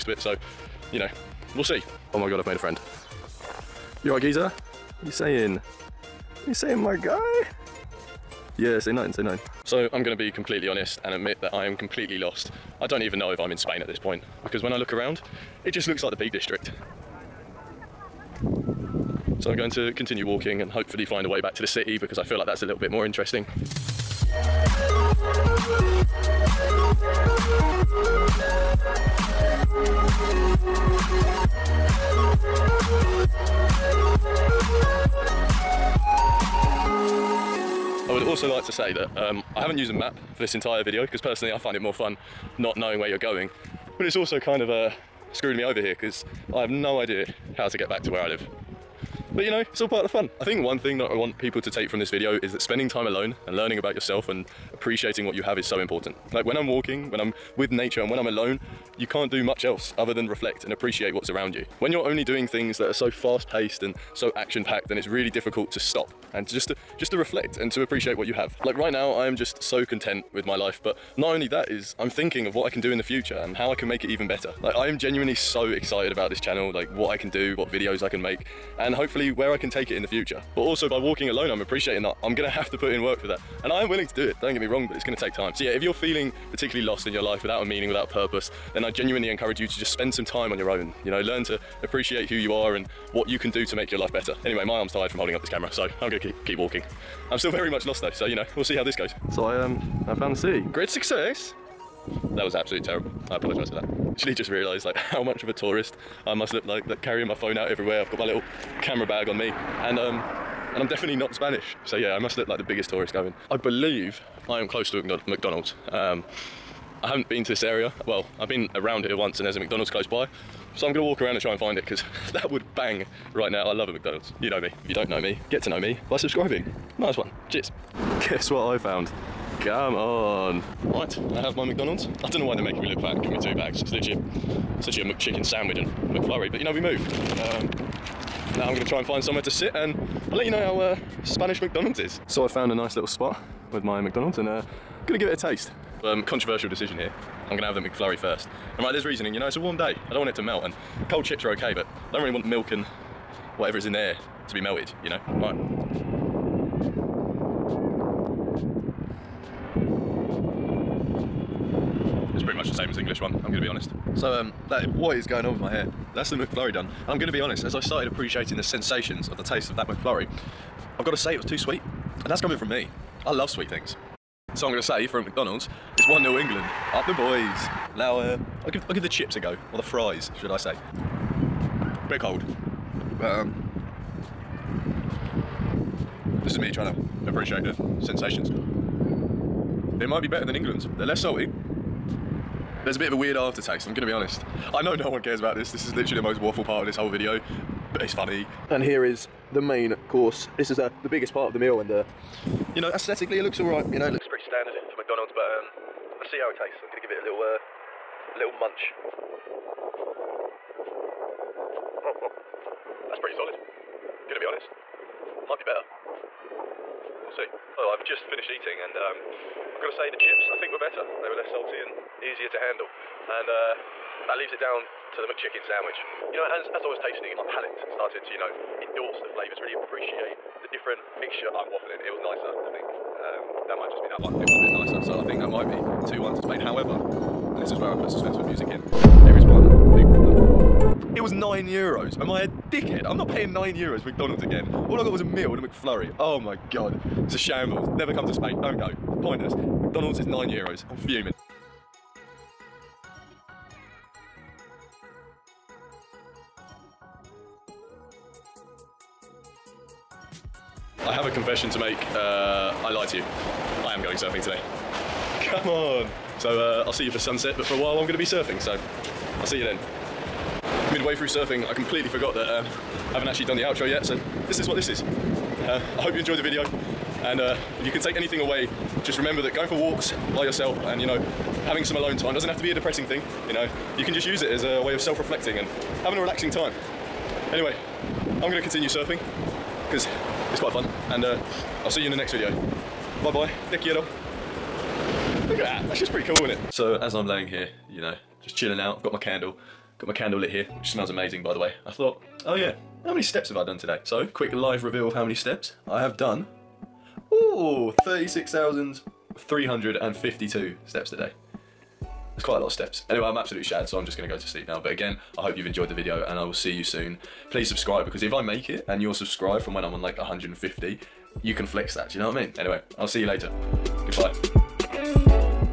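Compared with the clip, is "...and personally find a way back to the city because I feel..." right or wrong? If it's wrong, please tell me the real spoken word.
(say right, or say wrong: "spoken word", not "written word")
wrong: "hopefully", not "personally".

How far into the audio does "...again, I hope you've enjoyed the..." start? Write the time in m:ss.
5:14.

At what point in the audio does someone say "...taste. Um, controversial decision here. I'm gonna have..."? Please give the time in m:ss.
2:25.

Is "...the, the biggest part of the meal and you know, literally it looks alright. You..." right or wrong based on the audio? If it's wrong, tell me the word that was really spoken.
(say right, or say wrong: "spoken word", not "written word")
wrong: "aesthetically", not "literally".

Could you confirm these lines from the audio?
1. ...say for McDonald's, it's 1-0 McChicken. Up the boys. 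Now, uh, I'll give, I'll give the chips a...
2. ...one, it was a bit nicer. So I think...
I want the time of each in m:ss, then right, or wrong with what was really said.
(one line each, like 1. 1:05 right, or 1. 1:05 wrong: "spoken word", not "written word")
1. 2:54 wrong: "England", not "McChicken"
2. 3:54 right.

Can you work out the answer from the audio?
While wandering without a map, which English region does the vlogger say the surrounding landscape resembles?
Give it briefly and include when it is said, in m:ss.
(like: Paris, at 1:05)
Peak District, at 0:16.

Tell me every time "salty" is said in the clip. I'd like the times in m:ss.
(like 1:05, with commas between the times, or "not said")
3:11, 3:41.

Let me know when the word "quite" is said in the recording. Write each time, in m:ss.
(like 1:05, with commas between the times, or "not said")
4:50, 5:12.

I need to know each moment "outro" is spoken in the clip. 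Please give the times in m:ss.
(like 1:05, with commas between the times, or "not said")
4:33.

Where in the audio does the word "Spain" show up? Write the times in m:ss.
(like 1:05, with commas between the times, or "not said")
0:13, 3:56, 4:08.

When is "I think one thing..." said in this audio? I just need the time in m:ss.
0:50.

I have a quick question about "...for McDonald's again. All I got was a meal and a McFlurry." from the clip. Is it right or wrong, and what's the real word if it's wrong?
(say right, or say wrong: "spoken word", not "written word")
right.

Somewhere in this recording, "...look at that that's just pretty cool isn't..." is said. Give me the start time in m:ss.
4:55.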